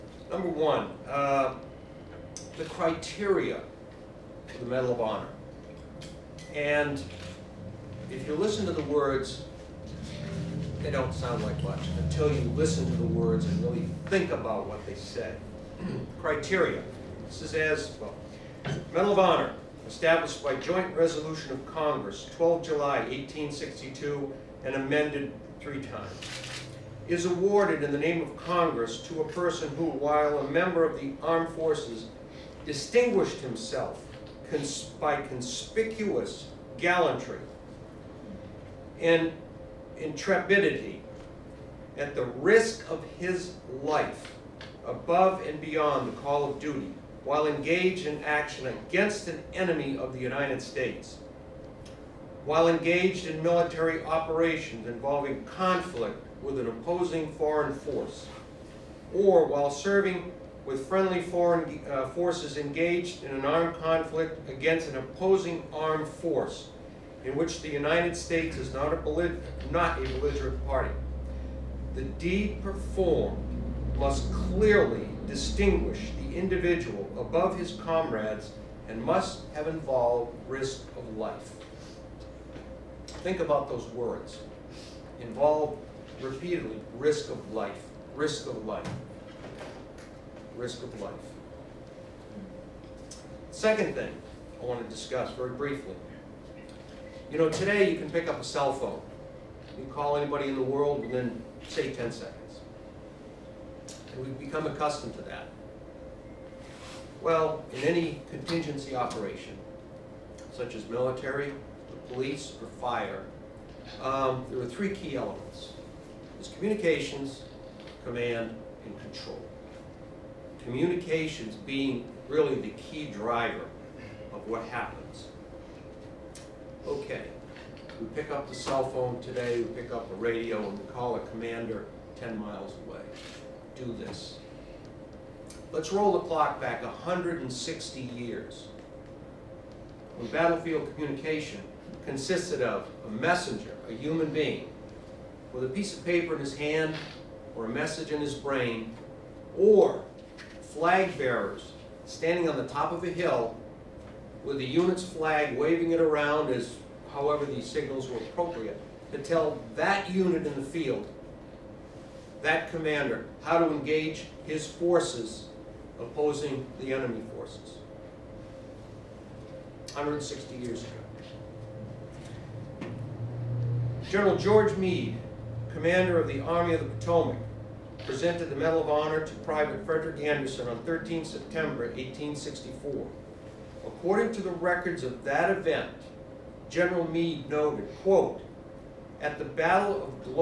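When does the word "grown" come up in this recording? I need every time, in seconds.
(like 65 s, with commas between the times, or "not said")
not said.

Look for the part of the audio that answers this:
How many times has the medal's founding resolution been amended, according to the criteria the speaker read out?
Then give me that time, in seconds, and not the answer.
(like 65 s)
25 s.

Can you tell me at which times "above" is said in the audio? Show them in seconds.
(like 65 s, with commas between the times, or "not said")
44 s, 77 s.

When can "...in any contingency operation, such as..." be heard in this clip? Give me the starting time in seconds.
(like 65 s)
107 s.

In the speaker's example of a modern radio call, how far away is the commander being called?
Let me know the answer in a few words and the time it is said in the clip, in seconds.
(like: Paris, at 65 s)
10 miles, at 132 s.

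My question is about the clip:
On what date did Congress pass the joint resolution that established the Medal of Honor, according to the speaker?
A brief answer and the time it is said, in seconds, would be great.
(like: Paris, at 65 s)
12 July 1862, at 22 s.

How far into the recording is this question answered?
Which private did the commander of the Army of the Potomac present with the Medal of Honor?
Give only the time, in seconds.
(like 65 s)
179 s.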